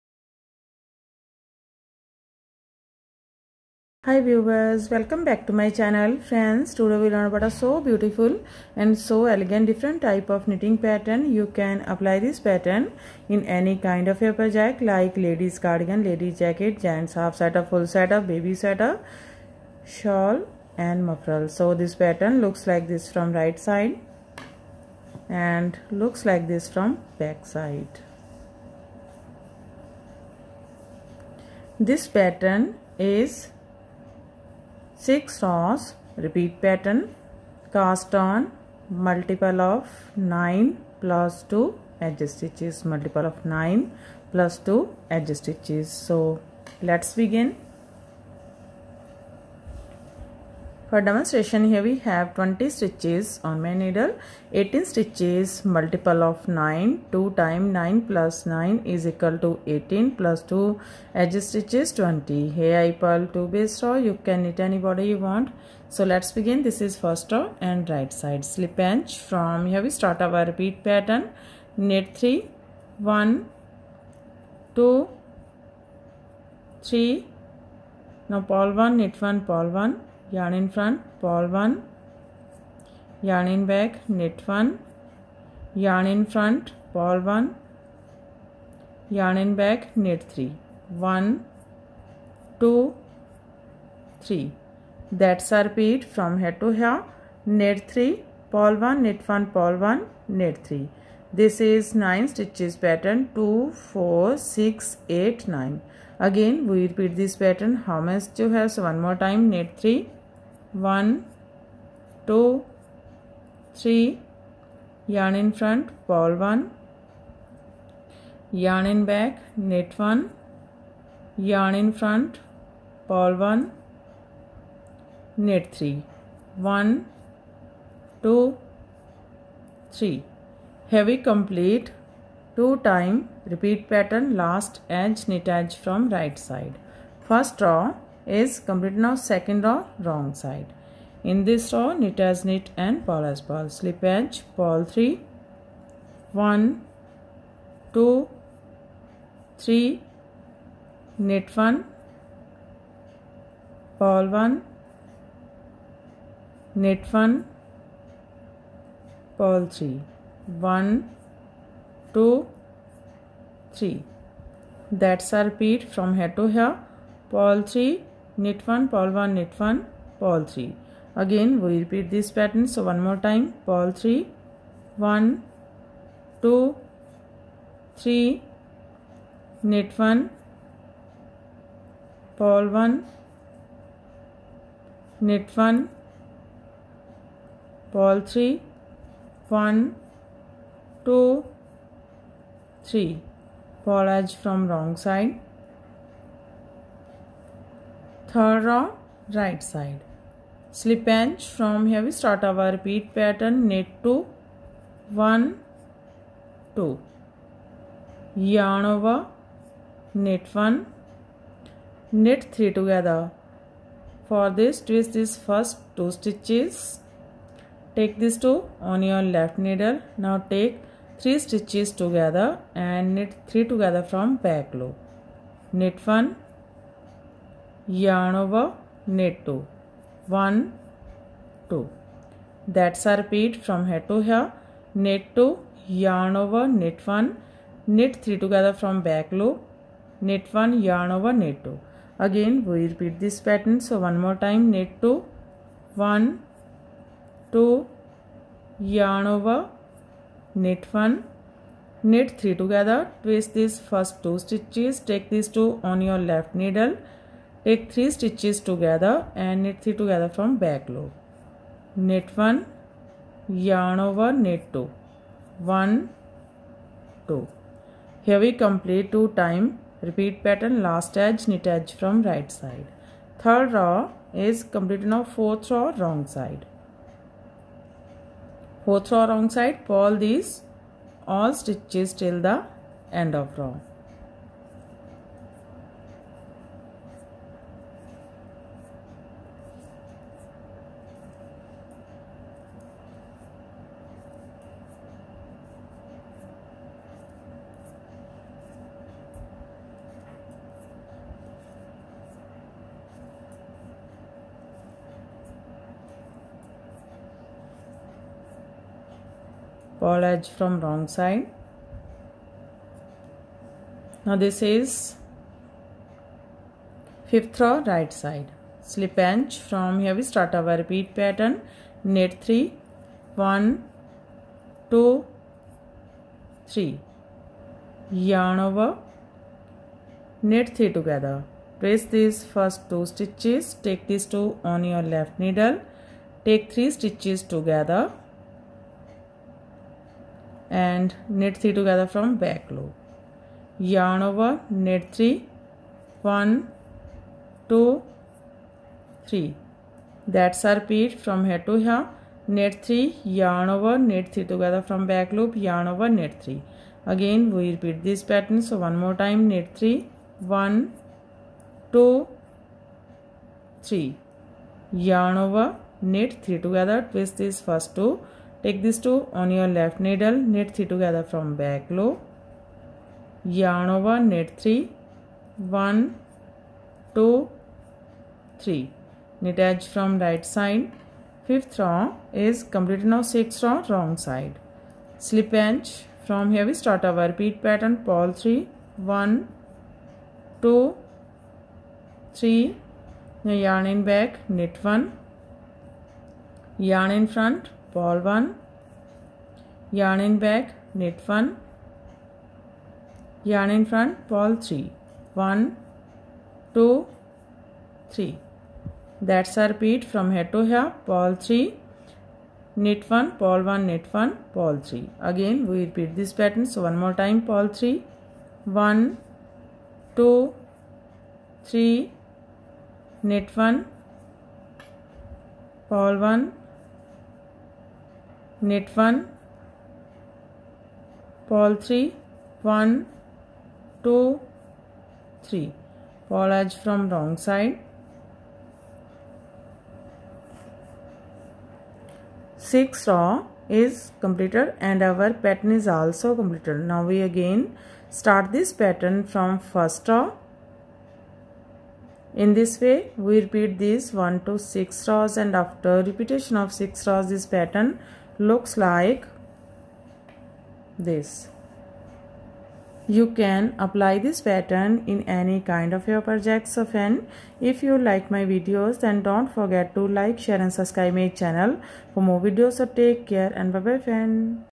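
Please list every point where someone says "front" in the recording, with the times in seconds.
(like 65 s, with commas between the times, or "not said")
80 s, 86 s, 115 s, 121 s, 397 s, 403 s.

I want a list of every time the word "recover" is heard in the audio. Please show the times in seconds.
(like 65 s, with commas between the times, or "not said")
not said.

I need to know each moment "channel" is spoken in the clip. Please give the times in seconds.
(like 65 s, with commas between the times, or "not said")
5 s, 471 s.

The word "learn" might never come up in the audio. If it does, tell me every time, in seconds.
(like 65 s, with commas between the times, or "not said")
7 s.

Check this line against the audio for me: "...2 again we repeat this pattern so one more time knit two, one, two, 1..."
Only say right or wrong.
right.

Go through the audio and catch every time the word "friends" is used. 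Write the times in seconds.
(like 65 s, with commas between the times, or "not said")
6 s, 474 s.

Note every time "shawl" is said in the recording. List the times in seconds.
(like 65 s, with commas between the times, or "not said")
19 s.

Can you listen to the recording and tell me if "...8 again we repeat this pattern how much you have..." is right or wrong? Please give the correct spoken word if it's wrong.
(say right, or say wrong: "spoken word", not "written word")
wrong: "9", not "8".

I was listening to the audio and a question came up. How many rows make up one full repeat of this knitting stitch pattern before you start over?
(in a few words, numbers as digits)
6.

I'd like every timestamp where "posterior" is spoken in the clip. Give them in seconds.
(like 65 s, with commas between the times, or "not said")
not said.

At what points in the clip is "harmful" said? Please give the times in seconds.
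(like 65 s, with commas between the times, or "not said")
not said.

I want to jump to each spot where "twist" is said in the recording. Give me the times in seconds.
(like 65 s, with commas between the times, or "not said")
214 s, 253 s, 367 s.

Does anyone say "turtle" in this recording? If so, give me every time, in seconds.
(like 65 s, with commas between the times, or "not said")
not said.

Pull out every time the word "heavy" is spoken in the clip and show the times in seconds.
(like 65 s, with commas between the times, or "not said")
130 s.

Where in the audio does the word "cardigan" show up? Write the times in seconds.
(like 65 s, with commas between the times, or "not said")
15 s.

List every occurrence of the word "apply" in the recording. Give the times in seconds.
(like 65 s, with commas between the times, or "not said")
11 s, 463 s.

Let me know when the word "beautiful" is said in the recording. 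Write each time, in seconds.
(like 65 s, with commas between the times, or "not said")
7 s.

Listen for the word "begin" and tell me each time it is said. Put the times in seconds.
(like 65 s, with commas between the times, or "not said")
47 s, 66 s.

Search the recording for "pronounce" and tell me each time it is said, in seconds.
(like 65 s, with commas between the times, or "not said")
not said.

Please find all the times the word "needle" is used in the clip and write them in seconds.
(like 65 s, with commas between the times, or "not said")
53 s, 219 s, 256 s, 335 s, 369 s.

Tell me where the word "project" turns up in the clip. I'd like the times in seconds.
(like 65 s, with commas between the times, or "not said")
14 s, 466 s.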